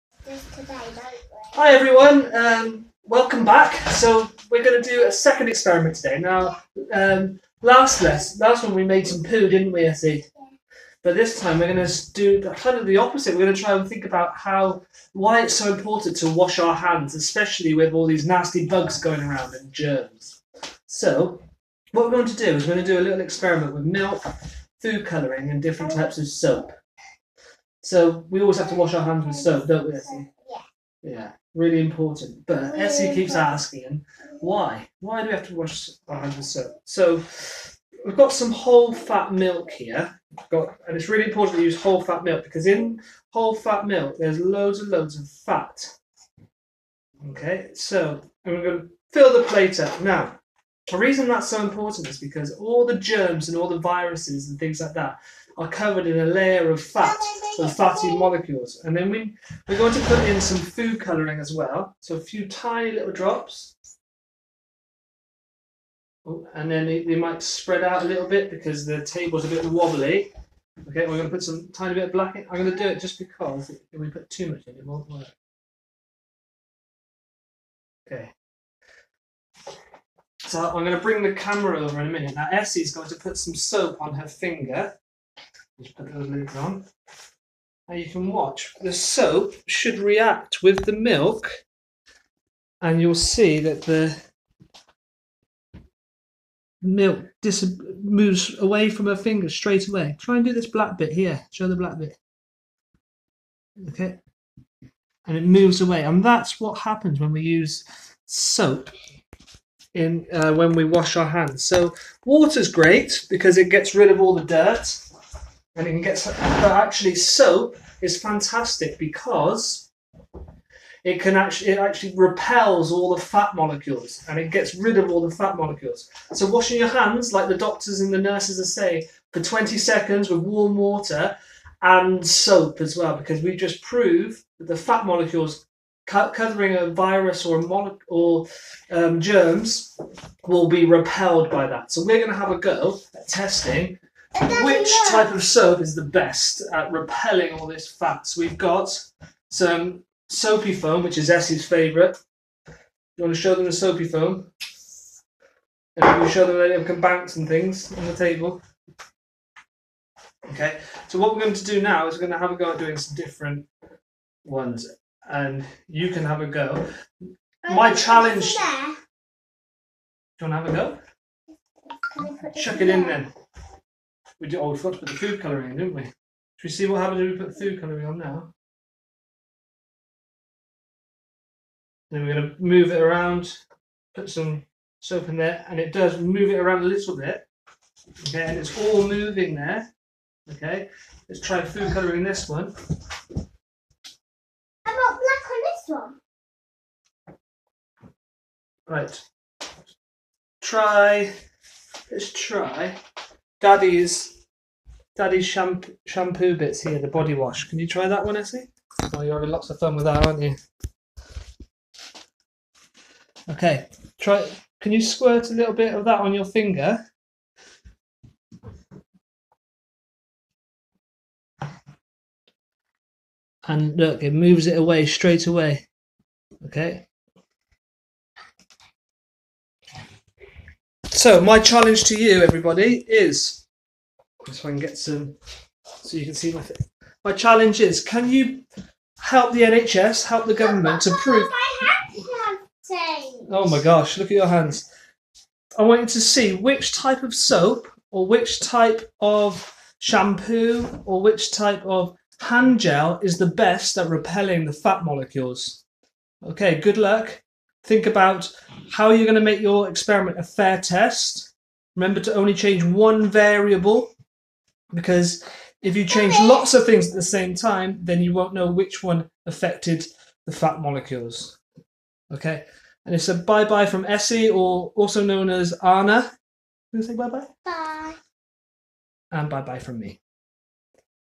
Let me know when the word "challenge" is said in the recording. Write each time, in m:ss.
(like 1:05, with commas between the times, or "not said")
2:47, 3:51, 3:57.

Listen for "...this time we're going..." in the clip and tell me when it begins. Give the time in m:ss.
0:11.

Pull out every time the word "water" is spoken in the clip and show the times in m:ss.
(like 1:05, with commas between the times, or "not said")
1:52, 2:10.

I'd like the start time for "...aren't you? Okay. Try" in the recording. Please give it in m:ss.
3:30.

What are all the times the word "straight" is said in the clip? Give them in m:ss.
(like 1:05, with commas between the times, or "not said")
1:39, 3:45.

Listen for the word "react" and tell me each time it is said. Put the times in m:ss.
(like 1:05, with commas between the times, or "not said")
1:29.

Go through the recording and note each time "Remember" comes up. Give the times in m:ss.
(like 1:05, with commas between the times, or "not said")
4:21.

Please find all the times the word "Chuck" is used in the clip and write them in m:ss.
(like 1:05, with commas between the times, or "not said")
2:52.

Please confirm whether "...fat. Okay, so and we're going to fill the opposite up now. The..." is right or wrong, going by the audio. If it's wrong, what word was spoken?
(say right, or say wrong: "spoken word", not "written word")
wrong: "plate", not "opposite".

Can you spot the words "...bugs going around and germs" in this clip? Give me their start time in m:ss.
0:18.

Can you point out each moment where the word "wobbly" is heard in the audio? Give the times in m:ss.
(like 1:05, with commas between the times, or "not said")
1:09.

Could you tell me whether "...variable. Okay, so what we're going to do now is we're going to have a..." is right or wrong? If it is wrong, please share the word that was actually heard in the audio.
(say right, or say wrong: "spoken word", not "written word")
wrong: "table", not "variable".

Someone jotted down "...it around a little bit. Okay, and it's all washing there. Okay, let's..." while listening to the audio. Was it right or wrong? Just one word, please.
wrong.